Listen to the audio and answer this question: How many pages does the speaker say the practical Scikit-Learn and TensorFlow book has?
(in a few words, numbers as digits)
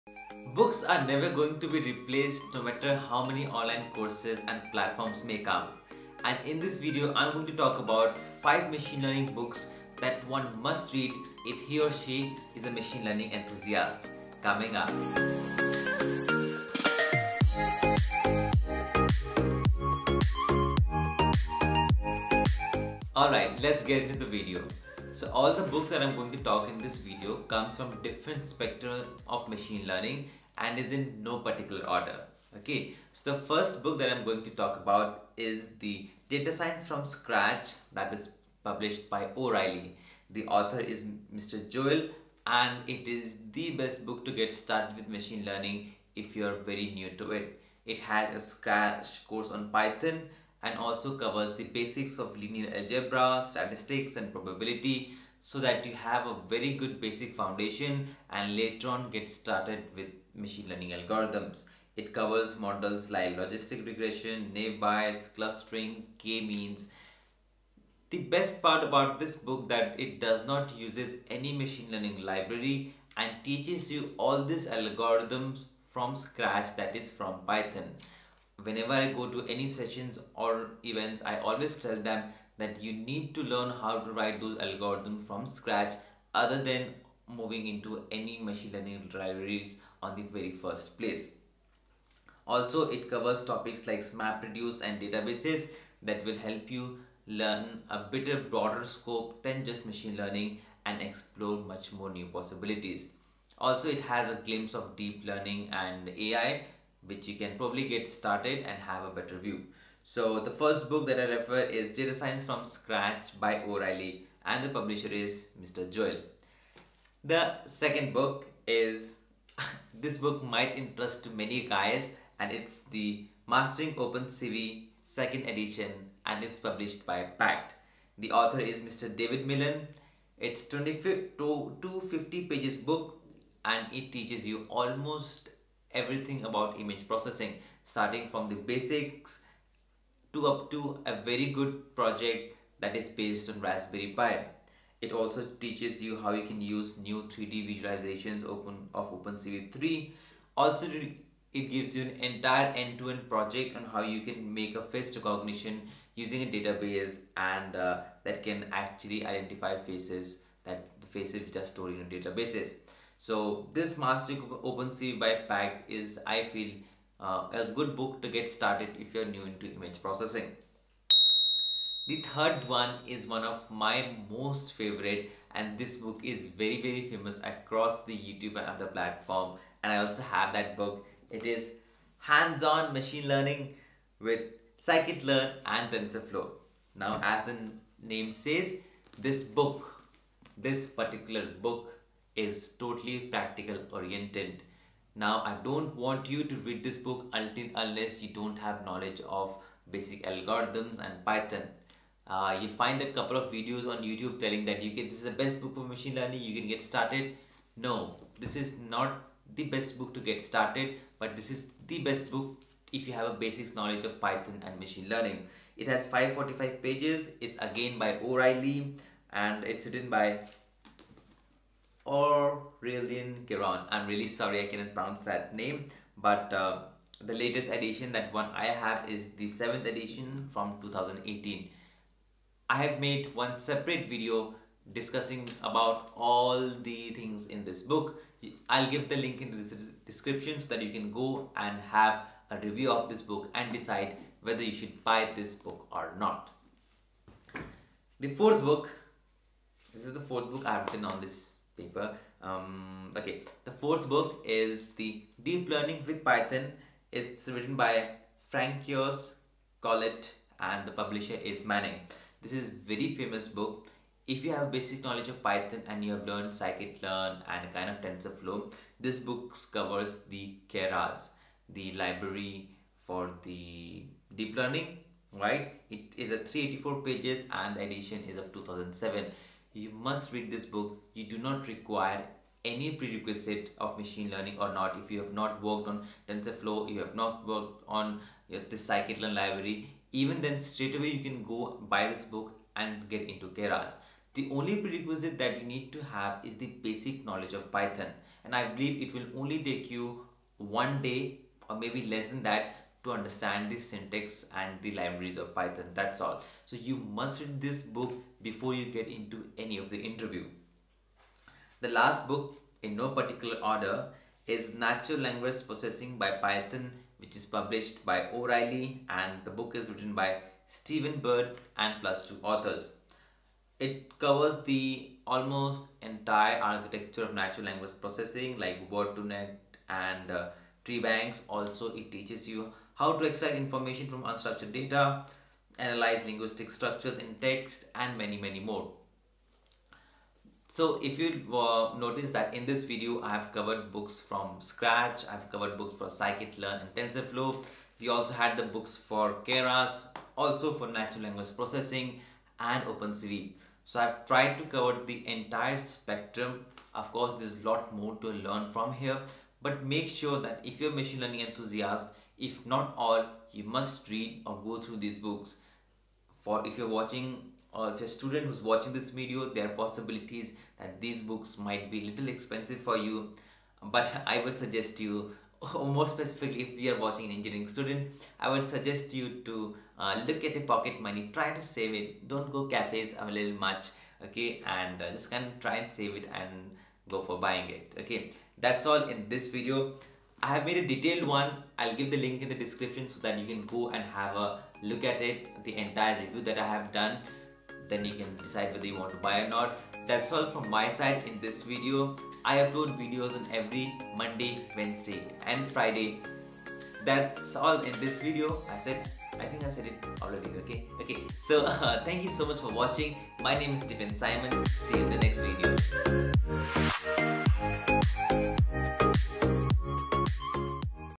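545.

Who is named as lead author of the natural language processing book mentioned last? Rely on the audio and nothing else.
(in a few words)
Steven Bird.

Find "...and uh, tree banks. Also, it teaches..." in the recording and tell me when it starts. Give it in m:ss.
5:29.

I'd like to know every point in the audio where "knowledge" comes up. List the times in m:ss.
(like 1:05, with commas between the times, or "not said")
3:18, 3:33, 4:25, 4:57.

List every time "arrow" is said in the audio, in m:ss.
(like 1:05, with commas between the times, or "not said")
not said.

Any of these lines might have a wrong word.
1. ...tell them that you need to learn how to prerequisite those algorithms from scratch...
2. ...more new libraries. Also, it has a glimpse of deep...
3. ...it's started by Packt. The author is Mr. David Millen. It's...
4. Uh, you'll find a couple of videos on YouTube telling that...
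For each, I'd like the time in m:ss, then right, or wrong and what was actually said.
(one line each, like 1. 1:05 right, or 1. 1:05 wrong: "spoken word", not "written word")
1. 1:21 wrong: "write", not "prerequisite"
2. 1:41 wrong: "possibilities", not "libraries"
3. 2:06 wrong: "published", not "started"
4. 3:22 right.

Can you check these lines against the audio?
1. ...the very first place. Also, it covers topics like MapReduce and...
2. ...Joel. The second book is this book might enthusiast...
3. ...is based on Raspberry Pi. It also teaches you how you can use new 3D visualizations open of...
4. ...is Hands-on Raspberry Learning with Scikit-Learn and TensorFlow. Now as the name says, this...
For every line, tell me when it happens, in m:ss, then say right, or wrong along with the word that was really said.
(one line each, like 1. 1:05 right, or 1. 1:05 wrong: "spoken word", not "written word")
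1. 1:30 right
2. 1:55 wrong: "interest", not "enthusiast"
3. 2:22 right
4. 3:01 wrong: "Machine", not "Raspberry".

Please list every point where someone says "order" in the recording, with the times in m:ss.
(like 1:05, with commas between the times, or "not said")
0:31, 5:13.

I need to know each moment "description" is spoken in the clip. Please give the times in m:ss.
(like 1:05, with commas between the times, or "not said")
4:00, 6:32.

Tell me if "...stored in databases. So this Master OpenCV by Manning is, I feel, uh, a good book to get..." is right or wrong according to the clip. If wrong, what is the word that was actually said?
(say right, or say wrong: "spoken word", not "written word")
wrong: "Packt", not "Manning".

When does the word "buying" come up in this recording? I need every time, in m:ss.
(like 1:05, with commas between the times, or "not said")
6:27.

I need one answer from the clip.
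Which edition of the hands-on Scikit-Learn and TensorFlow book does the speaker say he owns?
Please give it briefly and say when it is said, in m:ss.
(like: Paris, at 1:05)
7th edition, at 3:49.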